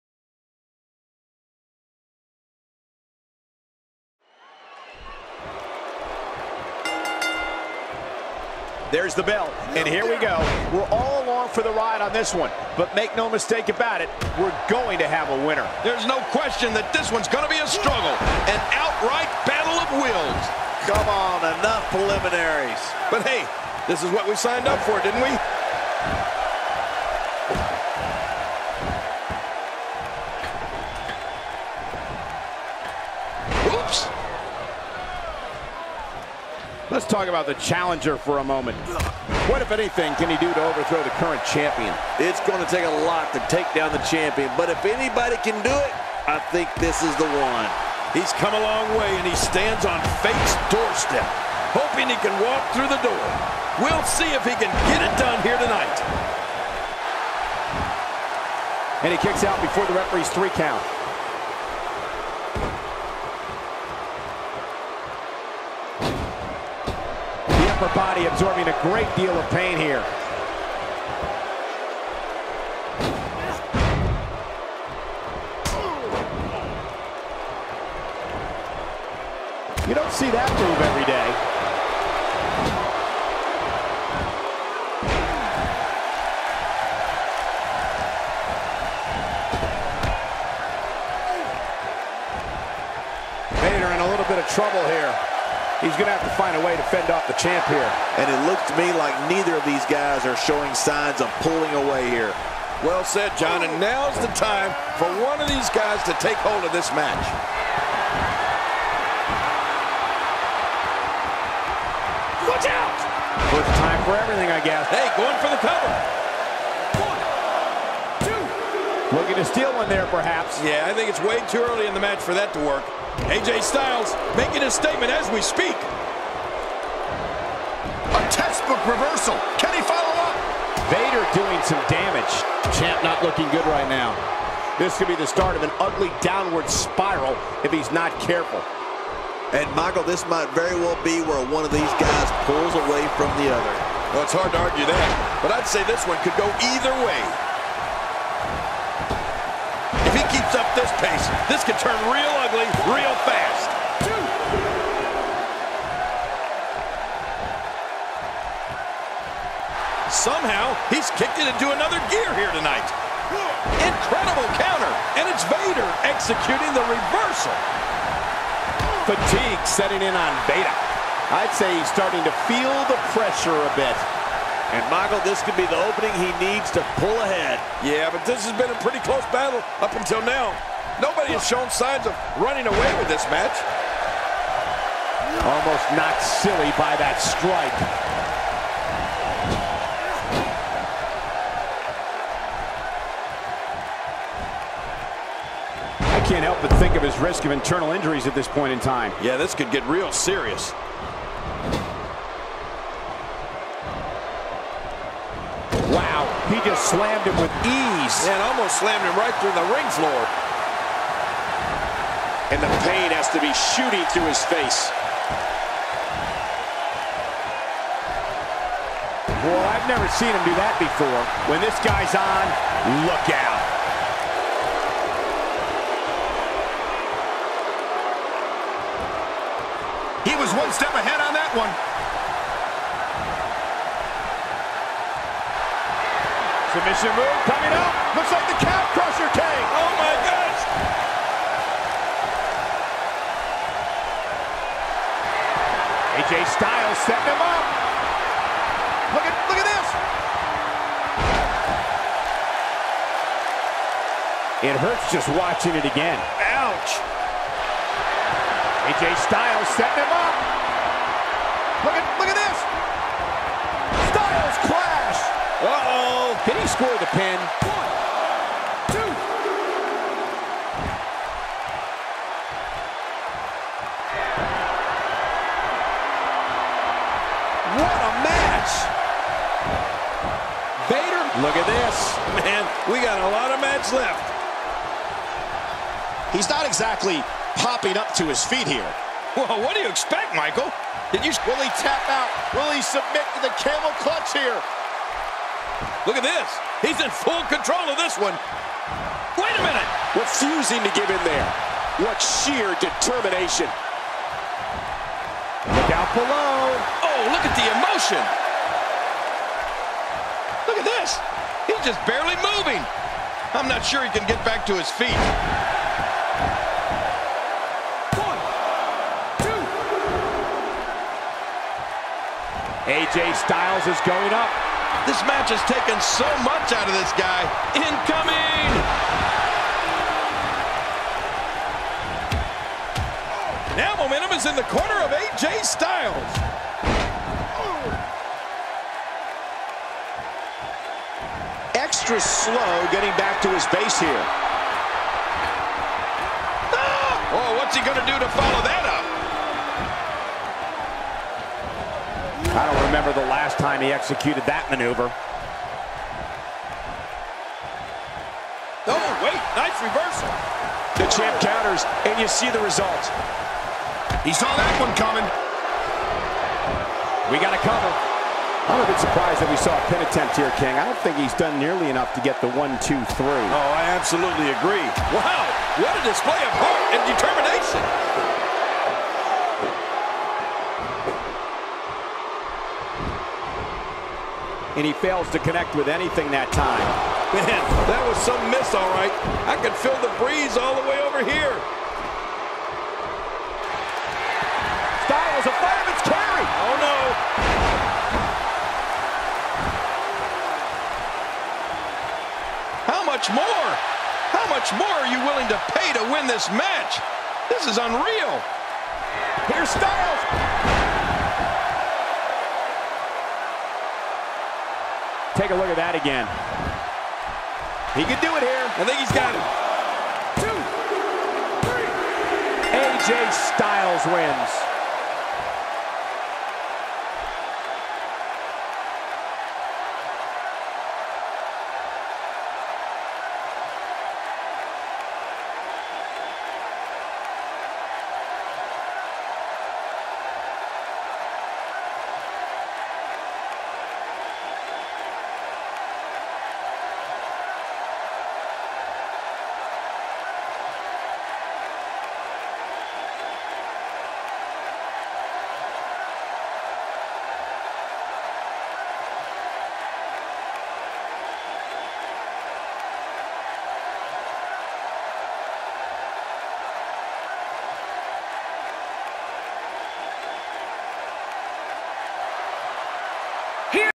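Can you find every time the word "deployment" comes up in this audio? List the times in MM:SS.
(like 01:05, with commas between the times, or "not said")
not said.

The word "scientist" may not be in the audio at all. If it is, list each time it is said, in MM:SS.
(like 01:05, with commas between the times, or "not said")
not said.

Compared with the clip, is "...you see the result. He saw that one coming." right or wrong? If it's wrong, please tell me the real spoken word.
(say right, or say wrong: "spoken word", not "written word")
right.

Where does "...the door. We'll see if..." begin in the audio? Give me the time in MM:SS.
00:52.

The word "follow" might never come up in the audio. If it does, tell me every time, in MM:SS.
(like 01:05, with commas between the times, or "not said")
02:09, 05:48.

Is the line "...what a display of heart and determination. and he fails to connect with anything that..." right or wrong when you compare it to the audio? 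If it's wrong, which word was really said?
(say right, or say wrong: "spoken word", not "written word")
right.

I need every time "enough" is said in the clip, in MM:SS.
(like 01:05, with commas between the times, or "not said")
00:21, 06:11.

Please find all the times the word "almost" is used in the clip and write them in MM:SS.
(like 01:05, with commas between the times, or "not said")
03:05, 03:28.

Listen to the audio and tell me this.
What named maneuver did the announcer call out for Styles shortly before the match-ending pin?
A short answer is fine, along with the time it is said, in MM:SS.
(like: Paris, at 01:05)
Fireman's carry, at 06:35.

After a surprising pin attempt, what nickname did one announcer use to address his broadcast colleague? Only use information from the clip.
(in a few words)
King.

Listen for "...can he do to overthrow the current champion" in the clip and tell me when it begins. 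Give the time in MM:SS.
00:40.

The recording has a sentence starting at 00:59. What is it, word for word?
And he kicks out before the referee's three count.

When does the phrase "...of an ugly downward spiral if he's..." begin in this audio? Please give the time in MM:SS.
02:15.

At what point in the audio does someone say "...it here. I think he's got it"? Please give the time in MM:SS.
06:58.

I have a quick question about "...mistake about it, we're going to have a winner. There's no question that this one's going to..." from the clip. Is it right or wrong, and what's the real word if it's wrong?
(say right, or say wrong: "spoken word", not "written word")
right.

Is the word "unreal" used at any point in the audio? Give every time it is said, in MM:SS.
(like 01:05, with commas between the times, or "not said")
06:47.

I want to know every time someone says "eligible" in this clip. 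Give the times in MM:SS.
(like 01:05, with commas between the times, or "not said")
not said.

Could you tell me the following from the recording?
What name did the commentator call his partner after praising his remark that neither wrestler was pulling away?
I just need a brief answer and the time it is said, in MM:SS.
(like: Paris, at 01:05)
John, at 01:43.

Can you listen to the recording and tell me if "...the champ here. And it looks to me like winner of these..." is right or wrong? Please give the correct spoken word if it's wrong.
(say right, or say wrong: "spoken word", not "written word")
wrong: "neither", not "winner".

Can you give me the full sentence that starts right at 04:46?
He's not exactly popping up to his feet here.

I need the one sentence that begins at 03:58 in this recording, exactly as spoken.
Looks like the calf crusher came.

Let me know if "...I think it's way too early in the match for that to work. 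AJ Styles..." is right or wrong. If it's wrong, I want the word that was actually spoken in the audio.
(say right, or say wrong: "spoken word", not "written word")
right.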